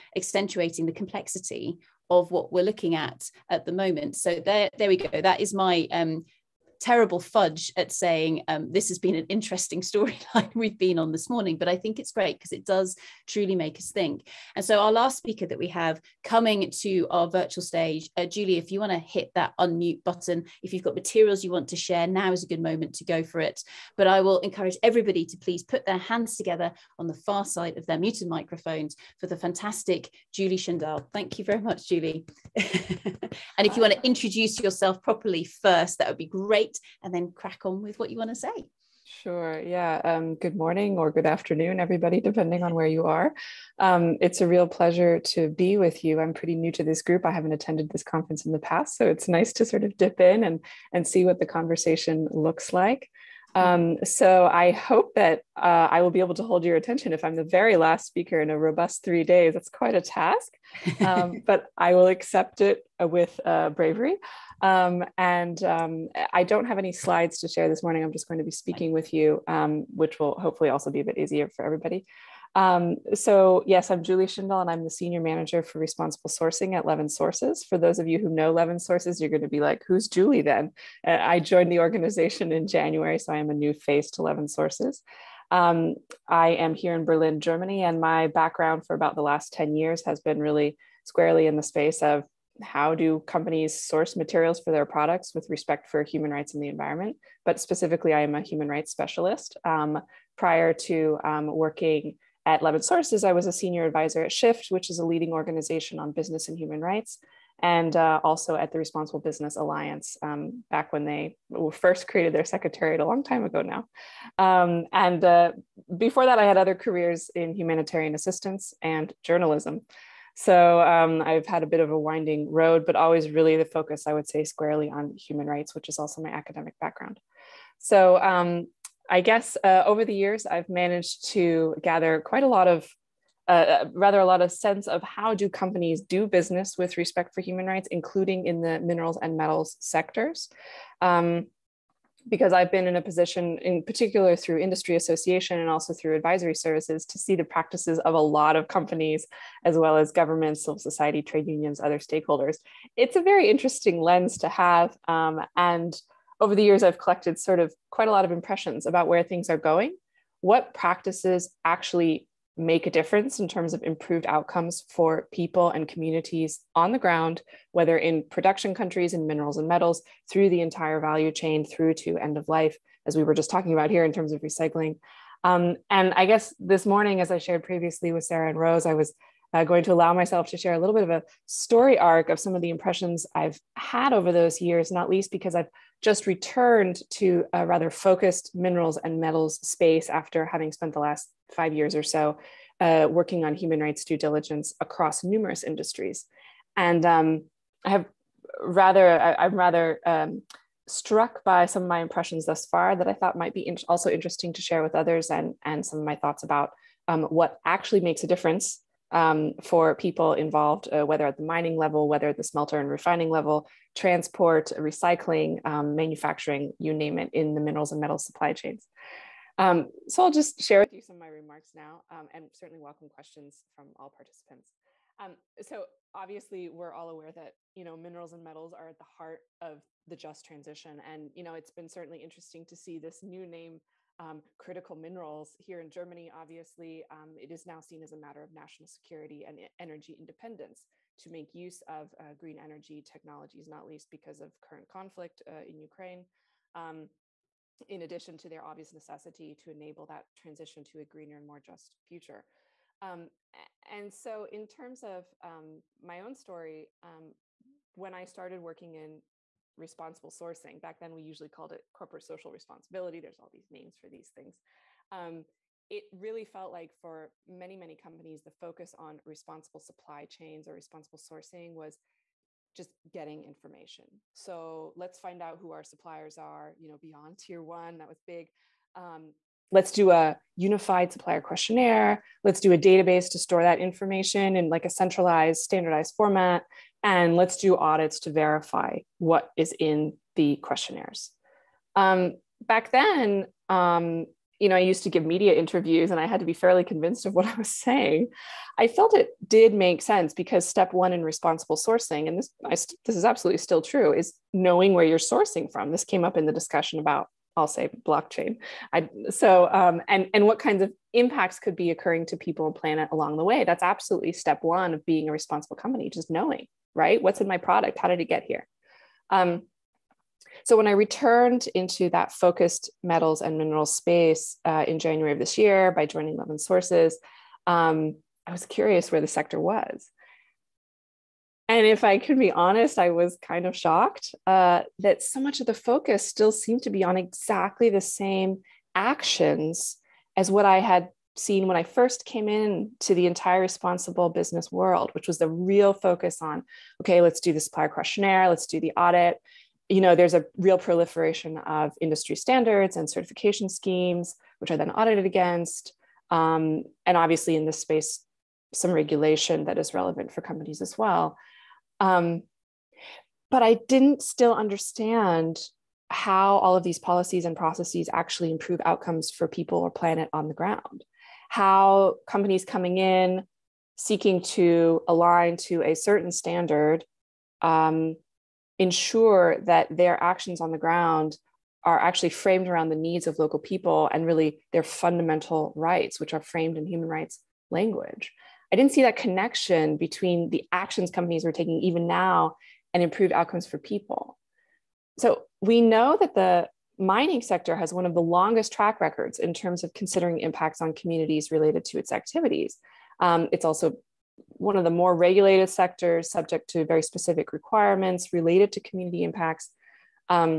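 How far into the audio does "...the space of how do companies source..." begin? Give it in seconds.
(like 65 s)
91 s.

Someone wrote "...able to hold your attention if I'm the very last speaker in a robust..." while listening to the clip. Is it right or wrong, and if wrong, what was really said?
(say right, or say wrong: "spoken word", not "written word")
right.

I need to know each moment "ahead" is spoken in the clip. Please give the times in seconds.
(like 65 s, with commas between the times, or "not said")
not said.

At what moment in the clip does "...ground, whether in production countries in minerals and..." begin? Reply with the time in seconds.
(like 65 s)
166 s.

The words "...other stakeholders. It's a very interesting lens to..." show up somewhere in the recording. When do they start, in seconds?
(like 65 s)
151 s.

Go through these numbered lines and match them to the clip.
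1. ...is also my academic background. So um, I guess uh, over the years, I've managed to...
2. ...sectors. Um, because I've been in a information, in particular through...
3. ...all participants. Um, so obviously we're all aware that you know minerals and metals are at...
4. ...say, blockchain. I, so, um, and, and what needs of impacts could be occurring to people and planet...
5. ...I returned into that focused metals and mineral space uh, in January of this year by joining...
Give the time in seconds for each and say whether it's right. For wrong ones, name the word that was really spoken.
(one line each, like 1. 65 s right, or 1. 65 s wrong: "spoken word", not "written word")
1. 125 s right
2. 139 s wrong: "position", not "information"
3. 223 s right
4. 307 s wrong: "kinds", not "needs"
5. 320 s right.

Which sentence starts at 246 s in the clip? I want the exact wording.
Um, in addition to their obvious necessity to enable that transition to a greener and more just future.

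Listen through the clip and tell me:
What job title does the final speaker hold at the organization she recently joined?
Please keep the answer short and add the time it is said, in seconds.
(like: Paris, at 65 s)
Senior manager for responsible sourcing, at 74 s.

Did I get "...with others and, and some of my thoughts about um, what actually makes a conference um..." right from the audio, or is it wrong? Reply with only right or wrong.
wrong.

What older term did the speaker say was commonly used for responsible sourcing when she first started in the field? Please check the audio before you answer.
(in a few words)
Corporate social responsibility.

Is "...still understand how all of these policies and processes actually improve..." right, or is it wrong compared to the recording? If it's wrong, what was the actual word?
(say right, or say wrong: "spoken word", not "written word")
right.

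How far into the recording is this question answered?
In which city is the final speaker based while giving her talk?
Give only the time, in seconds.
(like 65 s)
87 s.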